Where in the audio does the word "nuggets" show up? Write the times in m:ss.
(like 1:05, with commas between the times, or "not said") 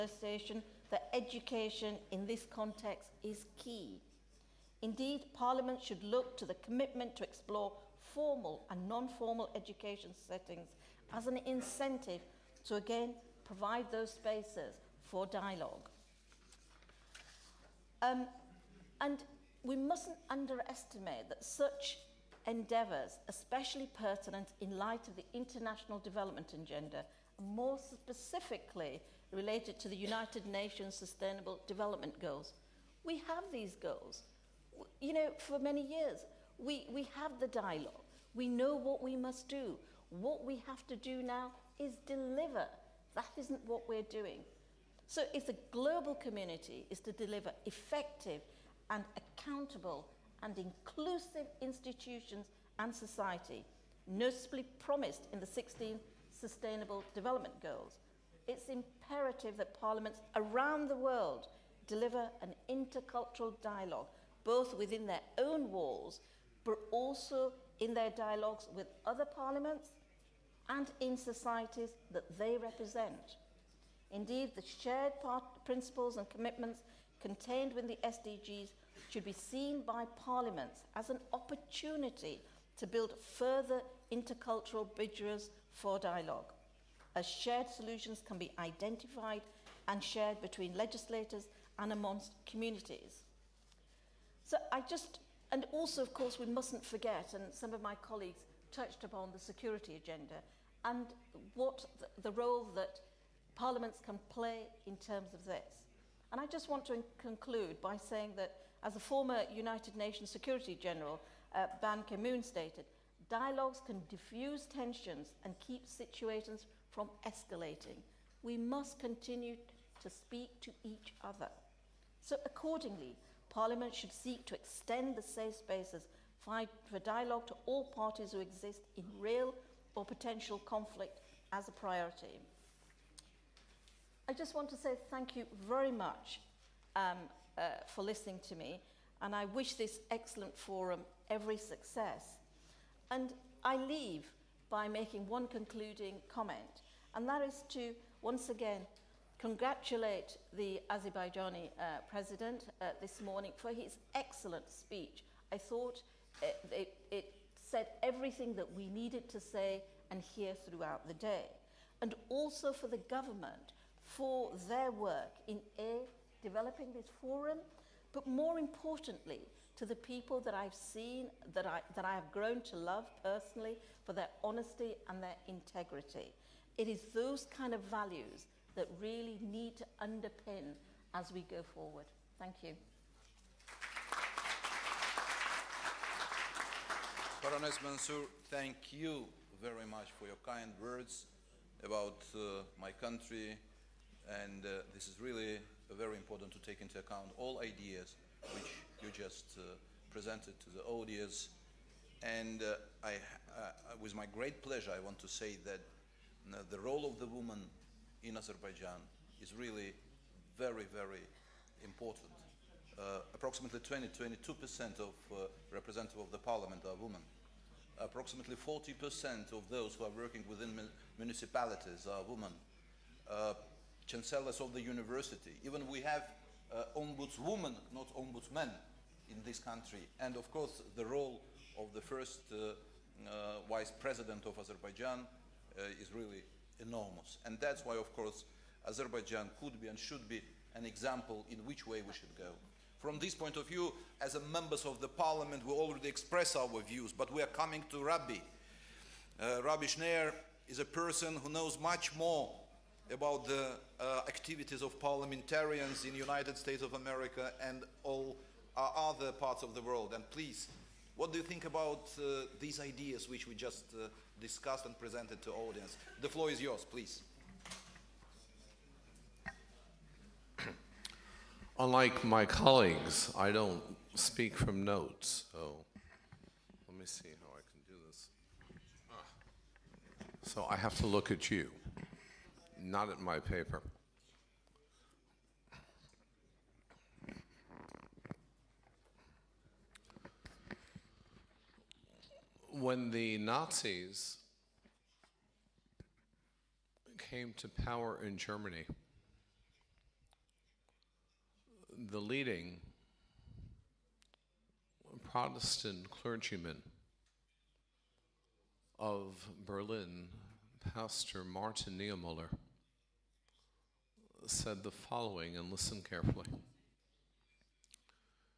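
not said.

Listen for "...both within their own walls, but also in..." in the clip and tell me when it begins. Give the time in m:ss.
1:04.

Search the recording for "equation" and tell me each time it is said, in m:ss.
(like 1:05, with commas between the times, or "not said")
not said.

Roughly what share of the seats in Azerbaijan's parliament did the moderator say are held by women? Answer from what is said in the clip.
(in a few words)
22%.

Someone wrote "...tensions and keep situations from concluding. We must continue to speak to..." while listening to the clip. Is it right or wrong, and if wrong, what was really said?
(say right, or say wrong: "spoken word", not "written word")
wrong: "escalating", not "concluding".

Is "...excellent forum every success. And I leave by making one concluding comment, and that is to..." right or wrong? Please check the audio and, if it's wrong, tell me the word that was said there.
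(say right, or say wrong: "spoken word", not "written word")
right.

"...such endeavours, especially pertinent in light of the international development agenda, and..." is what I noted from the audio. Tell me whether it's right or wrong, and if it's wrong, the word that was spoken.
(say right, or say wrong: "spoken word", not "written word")
right.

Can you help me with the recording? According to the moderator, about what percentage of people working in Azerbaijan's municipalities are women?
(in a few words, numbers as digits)
40%.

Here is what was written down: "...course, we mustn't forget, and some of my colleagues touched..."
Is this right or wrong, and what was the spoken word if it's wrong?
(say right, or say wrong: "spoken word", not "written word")
right.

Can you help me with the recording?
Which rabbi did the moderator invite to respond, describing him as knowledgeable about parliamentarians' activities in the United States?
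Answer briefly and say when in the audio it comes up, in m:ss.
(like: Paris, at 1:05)
Rabbi Schneier, at 4:09.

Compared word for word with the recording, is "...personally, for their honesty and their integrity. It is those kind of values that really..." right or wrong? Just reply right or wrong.
right.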